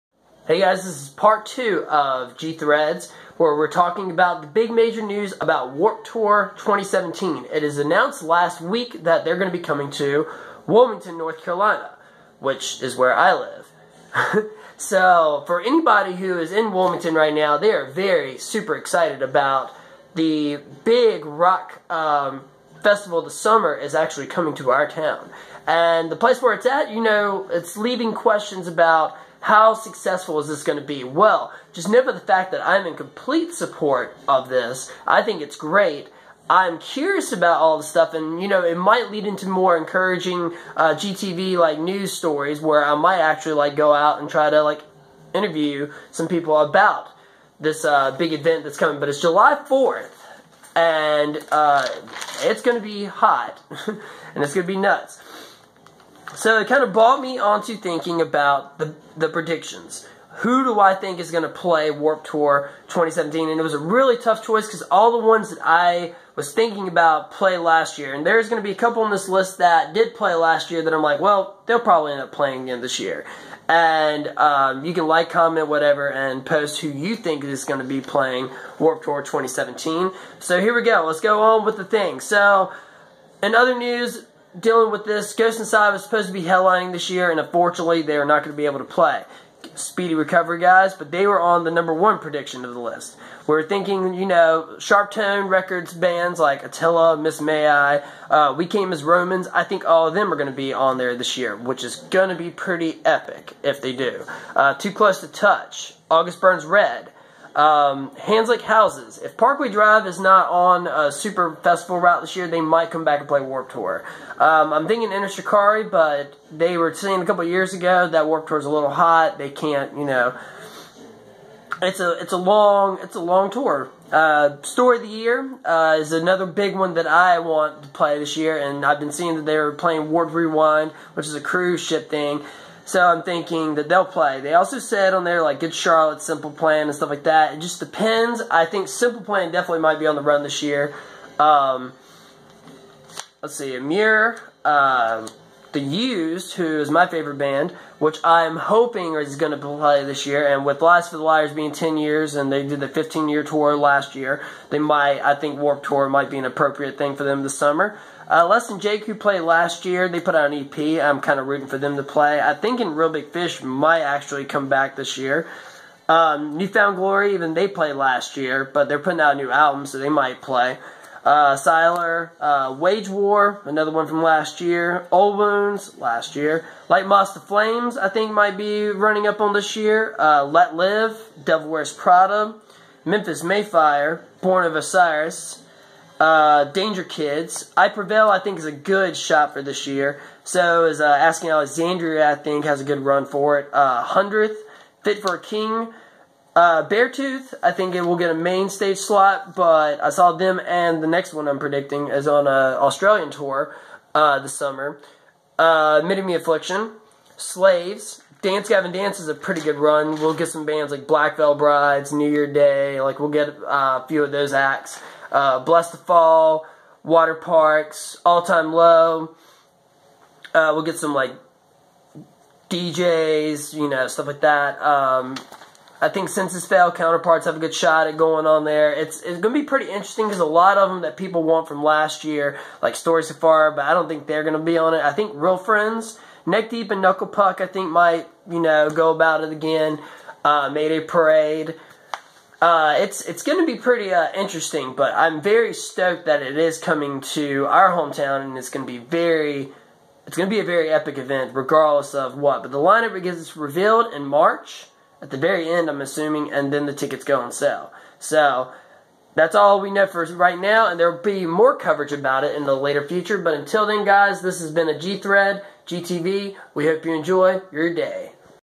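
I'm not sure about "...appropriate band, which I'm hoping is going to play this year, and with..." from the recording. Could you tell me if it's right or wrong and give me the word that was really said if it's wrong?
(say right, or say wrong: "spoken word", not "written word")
wrong: "favorite", not "appropriate".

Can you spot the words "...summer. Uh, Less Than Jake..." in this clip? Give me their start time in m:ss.
2:37.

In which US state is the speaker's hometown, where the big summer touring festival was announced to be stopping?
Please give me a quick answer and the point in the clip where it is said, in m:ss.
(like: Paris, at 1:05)
North Carolina, at 0:11.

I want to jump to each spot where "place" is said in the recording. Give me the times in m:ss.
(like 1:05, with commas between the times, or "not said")
0:26.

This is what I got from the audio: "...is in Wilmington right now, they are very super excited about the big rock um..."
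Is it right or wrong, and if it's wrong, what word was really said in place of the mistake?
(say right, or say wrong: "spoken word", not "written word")
right.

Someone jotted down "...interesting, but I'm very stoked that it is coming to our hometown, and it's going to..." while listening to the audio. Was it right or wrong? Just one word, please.
right.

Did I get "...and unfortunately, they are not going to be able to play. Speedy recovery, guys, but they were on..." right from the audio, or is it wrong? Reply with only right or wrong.
right.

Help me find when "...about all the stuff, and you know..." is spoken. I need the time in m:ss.
0:37.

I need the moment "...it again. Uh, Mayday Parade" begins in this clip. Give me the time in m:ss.
3:59.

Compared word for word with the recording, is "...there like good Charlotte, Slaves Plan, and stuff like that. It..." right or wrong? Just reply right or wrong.
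wrong.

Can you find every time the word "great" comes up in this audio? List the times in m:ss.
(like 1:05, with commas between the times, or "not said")
0:35.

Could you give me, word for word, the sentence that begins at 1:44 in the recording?
Uh, Too Close to Touch, August Burns Red, um, hands like houses.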